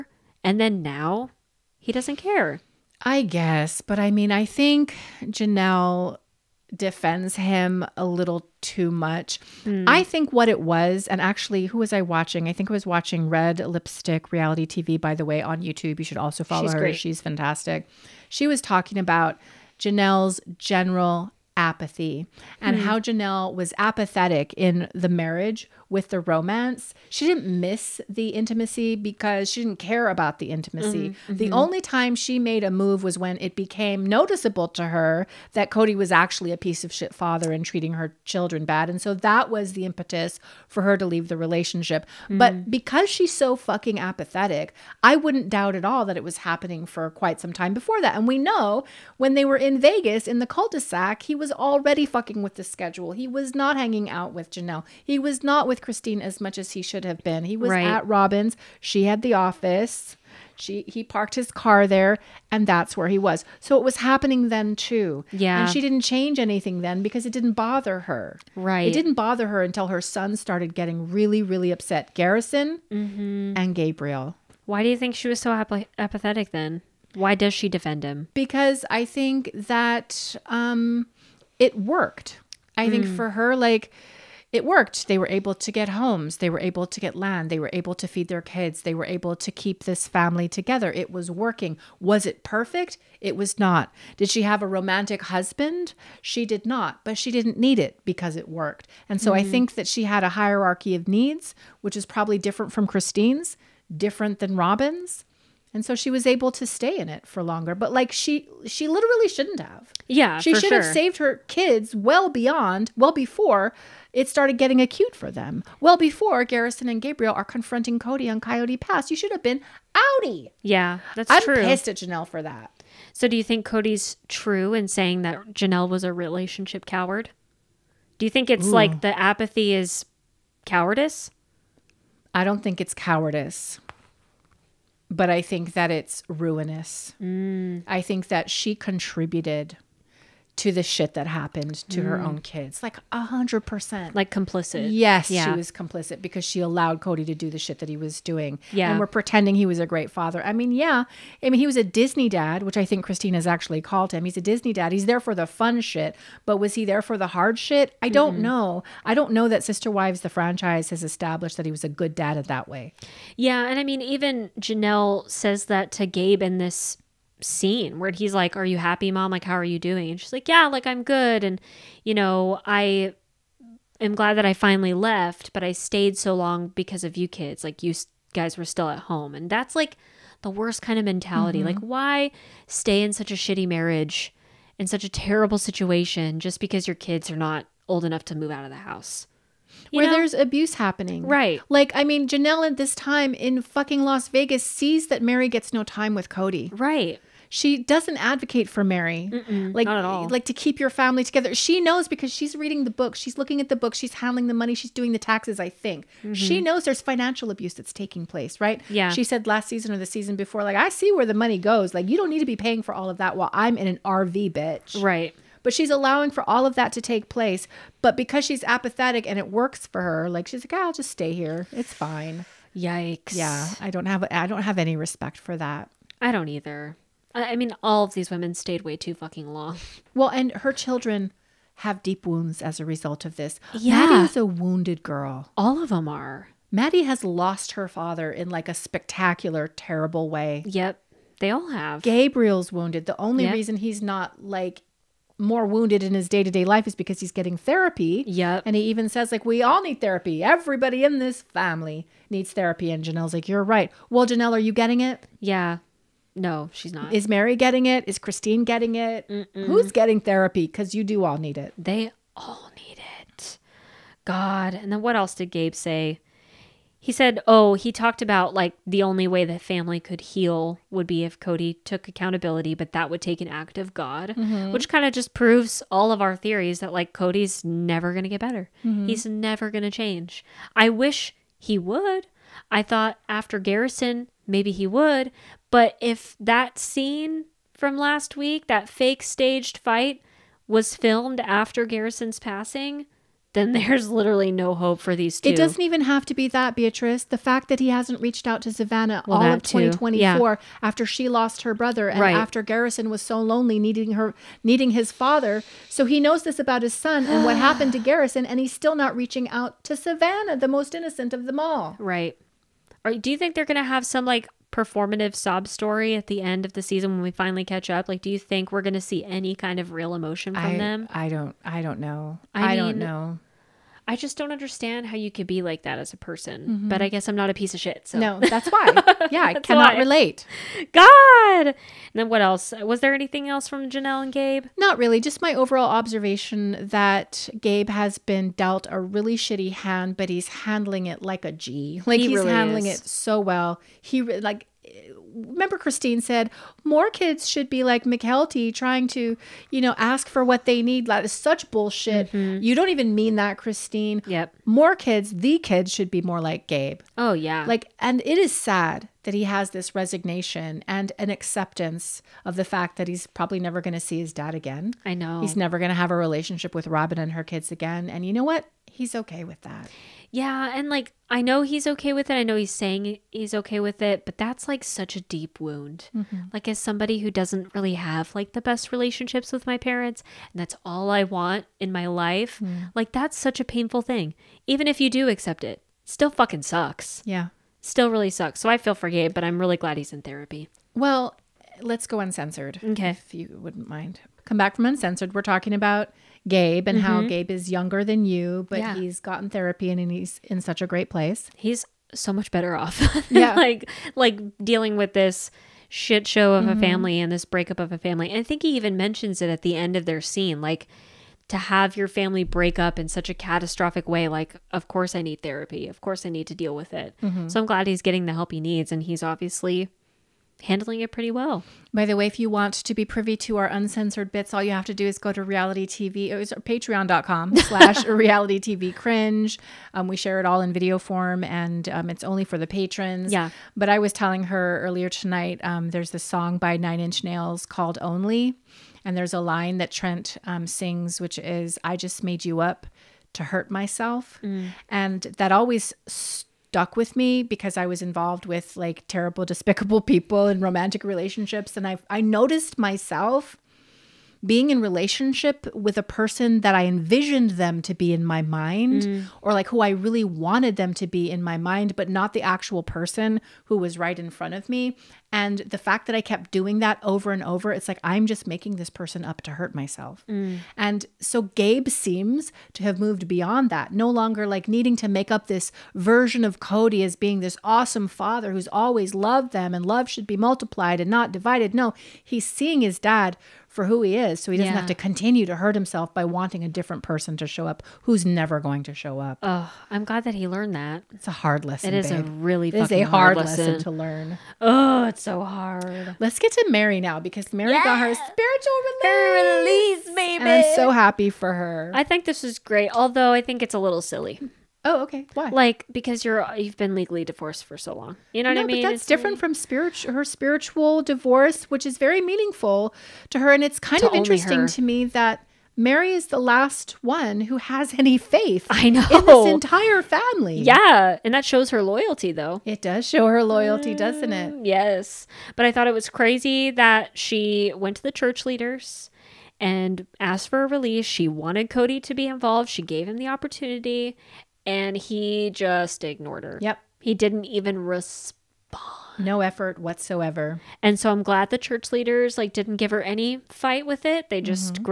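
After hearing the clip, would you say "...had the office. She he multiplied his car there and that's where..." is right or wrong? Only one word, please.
wrong.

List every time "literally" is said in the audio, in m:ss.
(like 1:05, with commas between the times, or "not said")
1:48, 4:54.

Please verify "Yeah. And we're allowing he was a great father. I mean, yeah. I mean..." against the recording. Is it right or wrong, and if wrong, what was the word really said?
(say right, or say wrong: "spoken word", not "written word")
wrong: "pretending", not "allowing".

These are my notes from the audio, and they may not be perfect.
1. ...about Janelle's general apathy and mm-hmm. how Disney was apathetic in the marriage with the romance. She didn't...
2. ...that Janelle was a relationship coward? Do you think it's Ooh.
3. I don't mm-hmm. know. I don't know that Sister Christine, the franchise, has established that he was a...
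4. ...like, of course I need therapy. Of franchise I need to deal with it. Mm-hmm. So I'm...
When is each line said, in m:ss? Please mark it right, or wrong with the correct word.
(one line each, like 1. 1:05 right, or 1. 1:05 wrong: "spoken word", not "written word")
1. 0:18 wrong: "Janelle", not "Disney"
2. 2:05 right
3. 2:38 wrong: "Wives", not "Christine"
4. 6:54 wrong: "course", not "franchise".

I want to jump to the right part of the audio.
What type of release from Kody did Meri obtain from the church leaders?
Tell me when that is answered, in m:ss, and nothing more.
8:18.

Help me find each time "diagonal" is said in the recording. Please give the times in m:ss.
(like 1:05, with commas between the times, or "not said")
not said.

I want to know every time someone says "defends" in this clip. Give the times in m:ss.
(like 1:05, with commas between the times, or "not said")
0:06, 1:17.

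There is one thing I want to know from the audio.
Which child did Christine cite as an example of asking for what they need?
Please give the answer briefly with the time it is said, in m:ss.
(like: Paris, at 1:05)
Mykelti, at 5:48.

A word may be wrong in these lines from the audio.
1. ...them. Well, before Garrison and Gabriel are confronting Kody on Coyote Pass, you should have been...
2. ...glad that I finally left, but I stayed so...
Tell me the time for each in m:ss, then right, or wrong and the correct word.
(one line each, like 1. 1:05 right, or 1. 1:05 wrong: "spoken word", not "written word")
1. 1:55 right
2. 2:54 right.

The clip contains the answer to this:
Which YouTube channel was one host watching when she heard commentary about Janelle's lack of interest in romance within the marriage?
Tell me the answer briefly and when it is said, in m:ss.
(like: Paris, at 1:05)
Red Lipstick Reality TV, at 0:13.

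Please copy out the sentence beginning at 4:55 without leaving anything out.
It doesn't even have to be that, Beatrice.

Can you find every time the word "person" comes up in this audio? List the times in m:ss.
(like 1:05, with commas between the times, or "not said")
5:26, 7:36, 7:42, 7:48, 8:07.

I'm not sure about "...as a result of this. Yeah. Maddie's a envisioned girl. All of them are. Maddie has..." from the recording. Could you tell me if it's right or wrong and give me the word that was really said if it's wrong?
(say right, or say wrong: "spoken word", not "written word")
wrong: "wounded", not "envisioned".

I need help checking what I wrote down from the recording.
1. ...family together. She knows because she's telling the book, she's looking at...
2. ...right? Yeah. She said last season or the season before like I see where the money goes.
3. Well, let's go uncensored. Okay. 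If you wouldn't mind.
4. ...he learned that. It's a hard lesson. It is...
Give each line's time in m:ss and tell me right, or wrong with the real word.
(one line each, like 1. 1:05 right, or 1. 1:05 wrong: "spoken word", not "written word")
1. 3:20 wrong: "reading", not "telling"
2. 3:28 right
3. 6:30 right
4. 8:10 right.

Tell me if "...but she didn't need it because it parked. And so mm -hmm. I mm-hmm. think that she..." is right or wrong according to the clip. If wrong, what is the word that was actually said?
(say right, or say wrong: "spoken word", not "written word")
wrong: "worked", not "parked".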